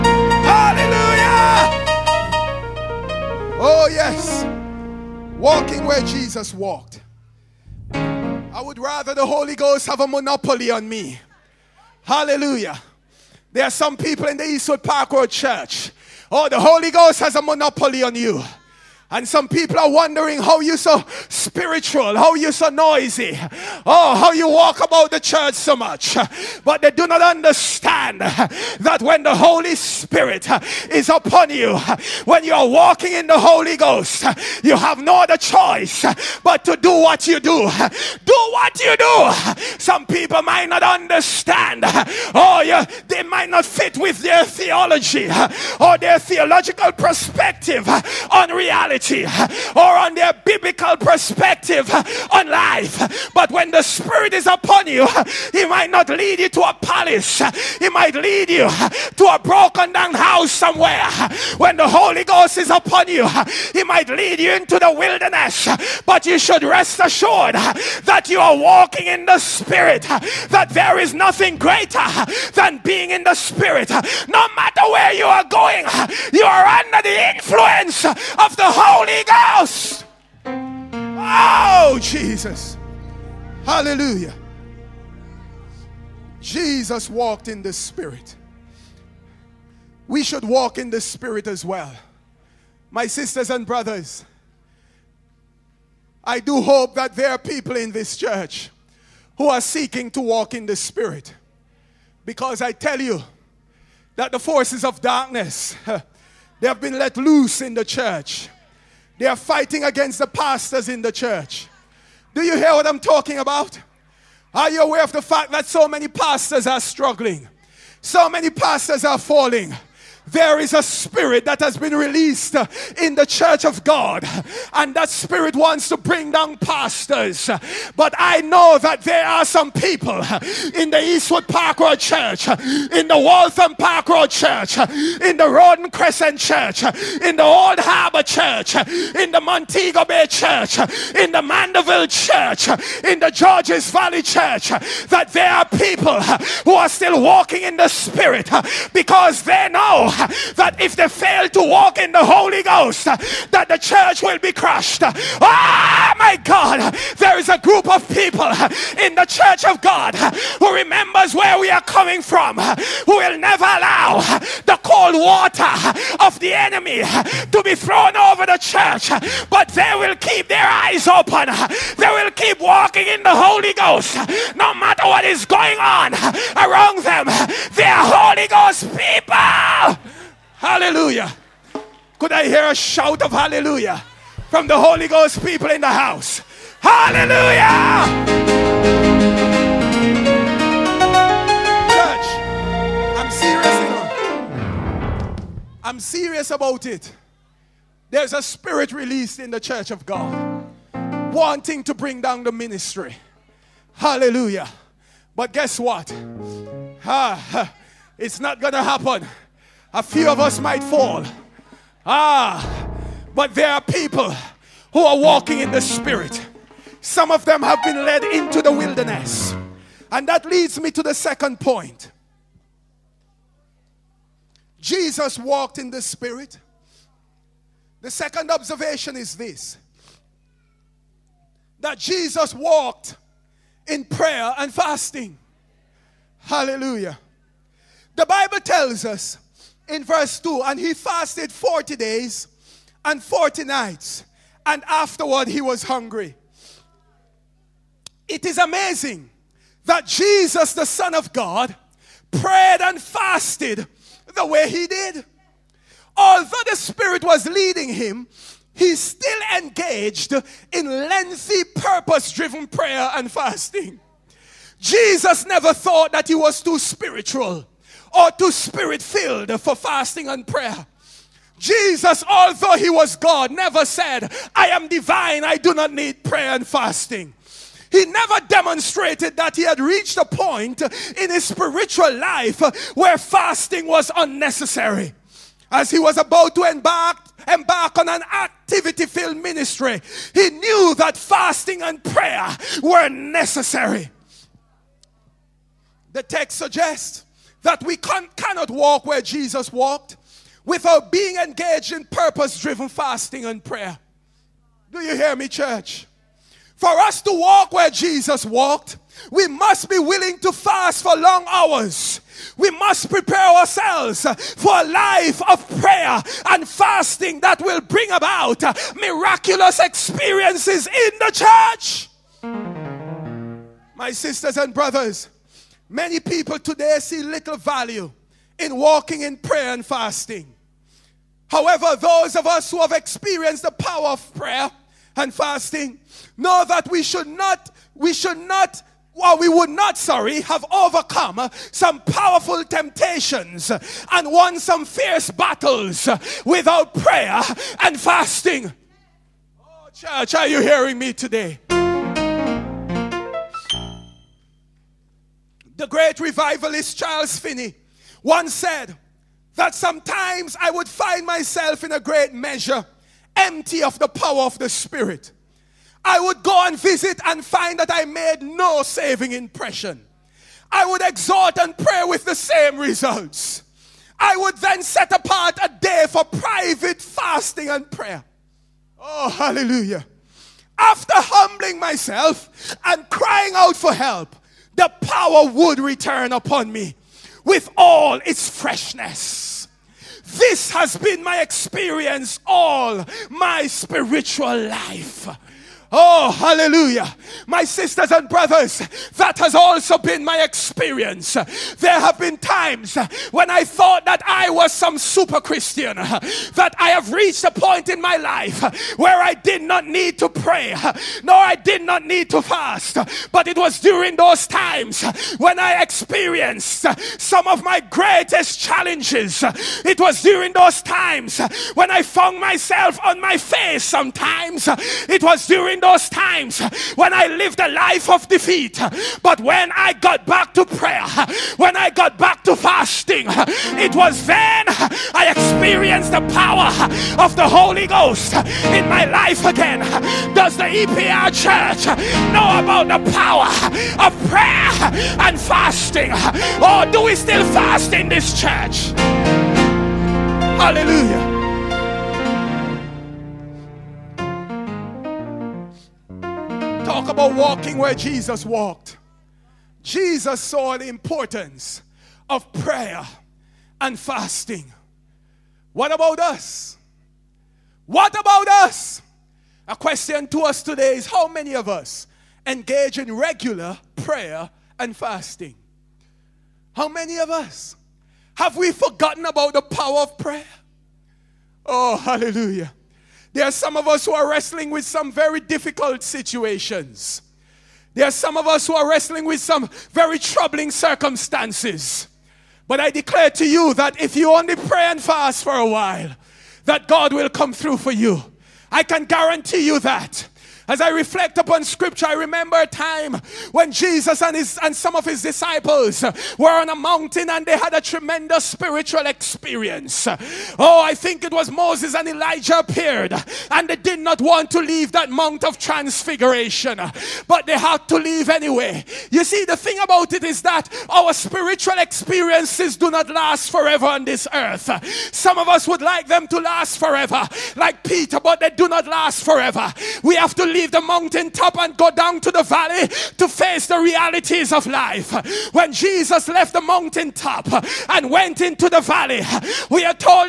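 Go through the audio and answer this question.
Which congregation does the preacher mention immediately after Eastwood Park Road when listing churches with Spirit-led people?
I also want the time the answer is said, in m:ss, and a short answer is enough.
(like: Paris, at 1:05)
Waltham Park Road Church, at 2:13.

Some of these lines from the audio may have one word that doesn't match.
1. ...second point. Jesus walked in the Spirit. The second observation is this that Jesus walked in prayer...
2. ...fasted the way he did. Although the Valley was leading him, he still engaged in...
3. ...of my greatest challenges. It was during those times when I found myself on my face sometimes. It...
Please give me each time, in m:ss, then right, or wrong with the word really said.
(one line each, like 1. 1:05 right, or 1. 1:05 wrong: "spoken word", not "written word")
1. 3:41 right
2. 4:13 wrong: "Spirit", not "Valley"
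3. 6:57 right.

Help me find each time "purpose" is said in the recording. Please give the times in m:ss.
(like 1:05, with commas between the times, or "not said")
4:21, 5:02.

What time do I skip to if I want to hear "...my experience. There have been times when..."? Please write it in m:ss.
6:40.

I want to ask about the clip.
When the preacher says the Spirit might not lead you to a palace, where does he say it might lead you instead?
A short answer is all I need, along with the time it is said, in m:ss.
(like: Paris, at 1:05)
a broken down house, at 0:59.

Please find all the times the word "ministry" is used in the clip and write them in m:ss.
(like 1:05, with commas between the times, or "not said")
3:22, 4:49.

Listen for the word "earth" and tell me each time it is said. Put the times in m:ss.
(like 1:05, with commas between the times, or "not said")
8:44.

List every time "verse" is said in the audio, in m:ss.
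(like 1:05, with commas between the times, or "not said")
4:00.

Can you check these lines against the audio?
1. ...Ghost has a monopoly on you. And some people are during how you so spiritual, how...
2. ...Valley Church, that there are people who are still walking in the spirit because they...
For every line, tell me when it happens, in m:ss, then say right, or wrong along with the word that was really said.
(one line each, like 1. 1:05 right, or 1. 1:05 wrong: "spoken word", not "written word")
1. 0:16 wrong: "wondering", not "during"
2. 2:23 right.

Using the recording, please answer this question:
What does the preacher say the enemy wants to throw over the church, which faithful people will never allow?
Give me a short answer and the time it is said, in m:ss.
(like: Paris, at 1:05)
cold water, at 2:44.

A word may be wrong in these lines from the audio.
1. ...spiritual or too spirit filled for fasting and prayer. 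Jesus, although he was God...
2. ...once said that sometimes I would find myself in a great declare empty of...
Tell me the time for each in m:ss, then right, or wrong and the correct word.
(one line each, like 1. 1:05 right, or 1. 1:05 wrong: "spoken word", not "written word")
1. 4:26 right
2. 5:58 wrong: "measure", not "declare".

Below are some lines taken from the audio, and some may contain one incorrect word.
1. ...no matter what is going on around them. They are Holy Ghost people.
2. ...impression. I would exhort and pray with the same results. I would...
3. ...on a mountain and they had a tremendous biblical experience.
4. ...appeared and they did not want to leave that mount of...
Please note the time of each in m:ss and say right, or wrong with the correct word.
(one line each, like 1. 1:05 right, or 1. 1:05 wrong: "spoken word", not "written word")
1. 2:54 right
2. 6:09 right
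3. 8:26 wrong: "spiritual", not "biblical"
4. 8:32 right.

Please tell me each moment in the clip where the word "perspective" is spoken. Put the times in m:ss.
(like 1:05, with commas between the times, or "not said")
0:46, 0:50.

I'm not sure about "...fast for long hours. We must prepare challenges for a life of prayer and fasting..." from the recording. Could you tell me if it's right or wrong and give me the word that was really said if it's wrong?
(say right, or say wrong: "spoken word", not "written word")
wrong: "ourselves", not "challenges".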